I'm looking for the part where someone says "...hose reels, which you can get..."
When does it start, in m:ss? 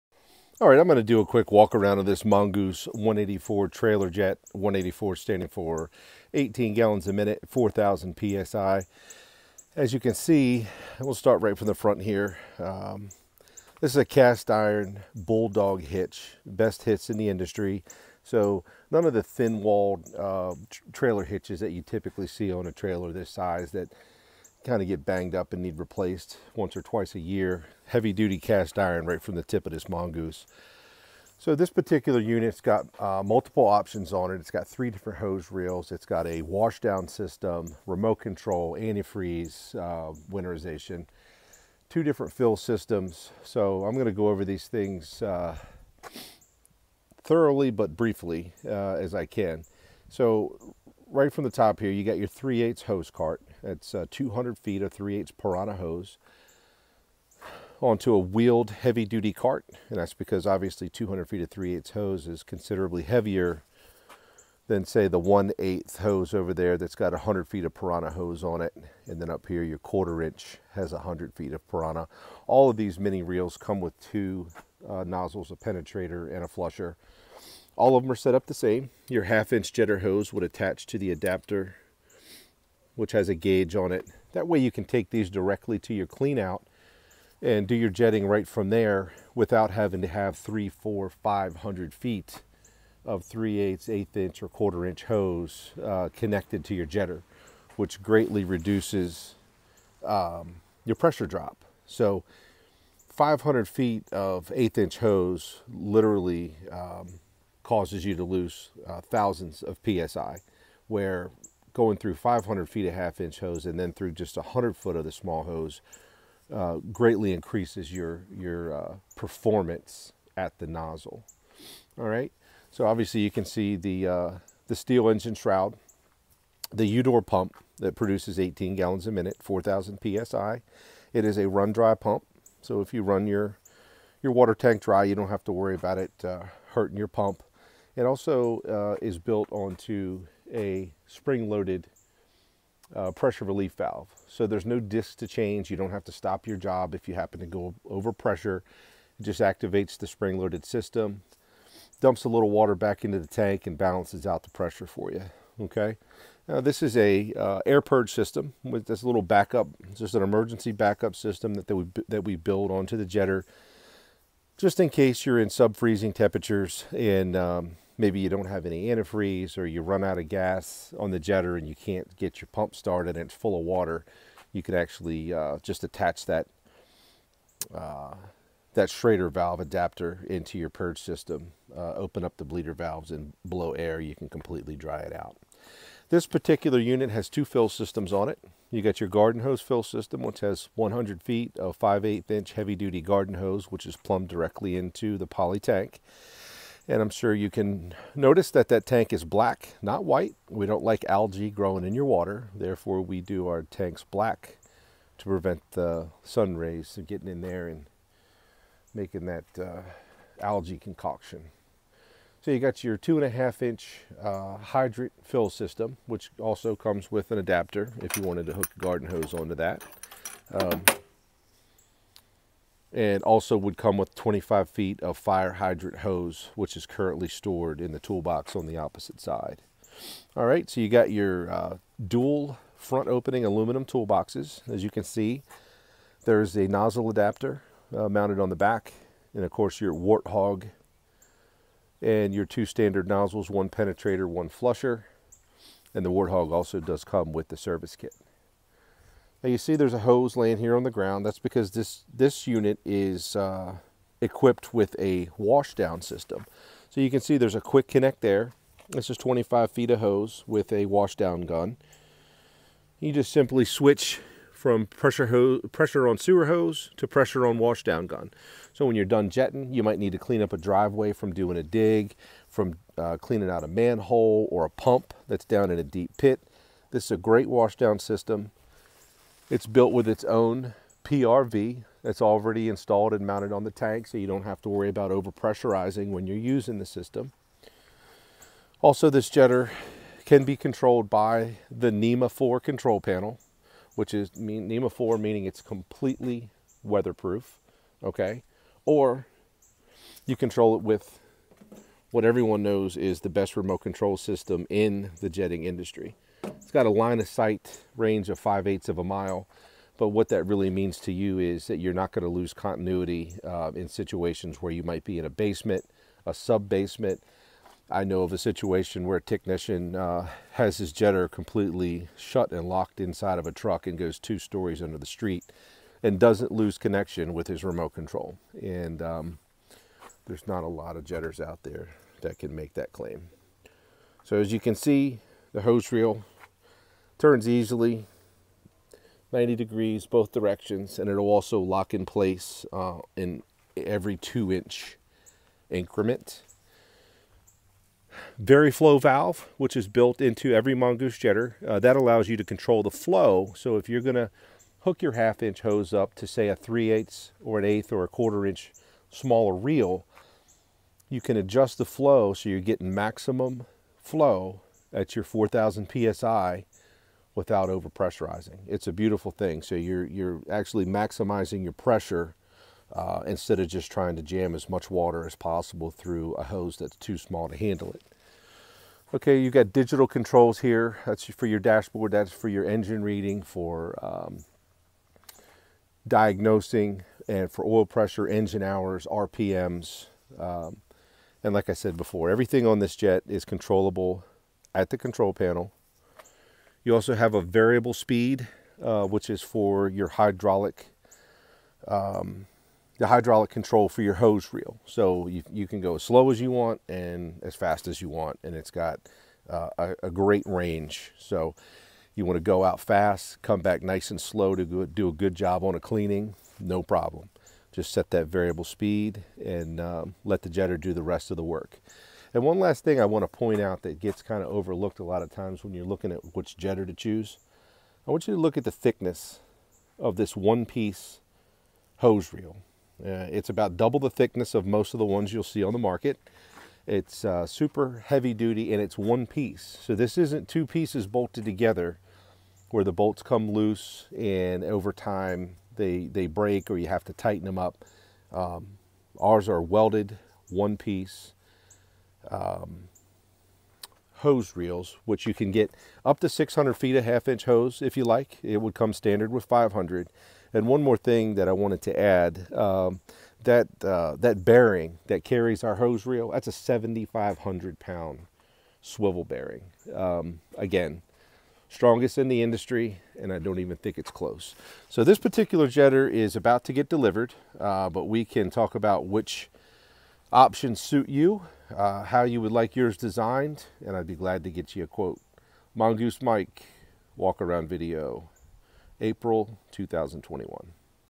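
7:34.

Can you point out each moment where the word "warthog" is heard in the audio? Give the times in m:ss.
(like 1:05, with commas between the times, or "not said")
3:59, 4:06.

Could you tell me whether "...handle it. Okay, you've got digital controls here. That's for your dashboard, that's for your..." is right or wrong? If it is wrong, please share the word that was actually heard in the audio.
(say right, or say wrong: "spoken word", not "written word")
right.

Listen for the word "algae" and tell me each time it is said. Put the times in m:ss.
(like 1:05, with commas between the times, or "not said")
3:21, 3:30.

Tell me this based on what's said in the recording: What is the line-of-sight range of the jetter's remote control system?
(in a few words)
5/8 of a mile.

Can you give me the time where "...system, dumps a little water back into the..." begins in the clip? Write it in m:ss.
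2:30.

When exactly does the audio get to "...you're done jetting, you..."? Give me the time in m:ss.
4:28.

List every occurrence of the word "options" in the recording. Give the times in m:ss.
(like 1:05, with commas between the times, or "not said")
0:33, 8:00.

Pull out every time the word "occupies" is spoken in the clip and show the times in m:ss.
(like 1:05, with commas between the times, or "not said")
not said.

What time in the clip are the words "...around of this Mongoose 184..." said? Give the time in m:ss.
0:01.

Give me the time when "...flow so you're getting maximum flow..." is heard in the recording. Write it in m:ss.
6:01.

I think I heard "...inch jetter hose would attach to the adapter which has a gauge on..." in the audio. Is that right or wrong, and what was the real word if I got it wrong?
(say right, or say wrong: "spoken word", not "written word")
right.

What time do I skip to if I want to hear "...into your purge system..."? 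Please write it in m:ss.
3:00.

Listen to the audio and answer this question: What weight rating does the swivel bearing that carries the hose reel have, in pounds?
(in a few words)
7,500 pounds.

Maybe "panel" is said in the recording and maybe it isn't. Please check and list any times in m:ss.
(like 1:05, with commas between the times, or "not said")
4:53, 6:35.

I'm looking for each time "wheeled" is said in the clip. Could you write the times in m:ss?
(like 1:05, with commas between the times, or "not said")
0:58.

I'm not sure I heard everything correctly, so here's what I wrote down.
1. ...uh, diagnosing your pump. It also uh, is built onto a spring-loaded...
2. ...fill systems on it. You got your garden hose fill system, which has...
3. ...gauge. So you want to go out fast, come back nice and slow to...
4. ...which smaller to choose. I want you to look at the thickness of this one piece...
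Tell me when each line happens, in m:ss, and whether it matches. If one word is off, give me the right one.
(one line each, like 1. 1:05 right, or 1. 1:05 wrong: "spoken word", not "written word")
1. 2:16 wrong: "hurting", not "diagnosing"
2. 3:07 right
3. 6:50 wrong: "range", not "gauge"
4. 7:06 wrong: "jetter", not "smaller".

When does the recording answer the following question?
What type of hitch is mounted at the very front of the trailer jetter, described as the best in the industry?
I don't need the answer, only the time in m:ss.
0:14.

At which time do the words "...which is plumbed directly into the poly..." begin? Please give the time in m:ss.
3:13.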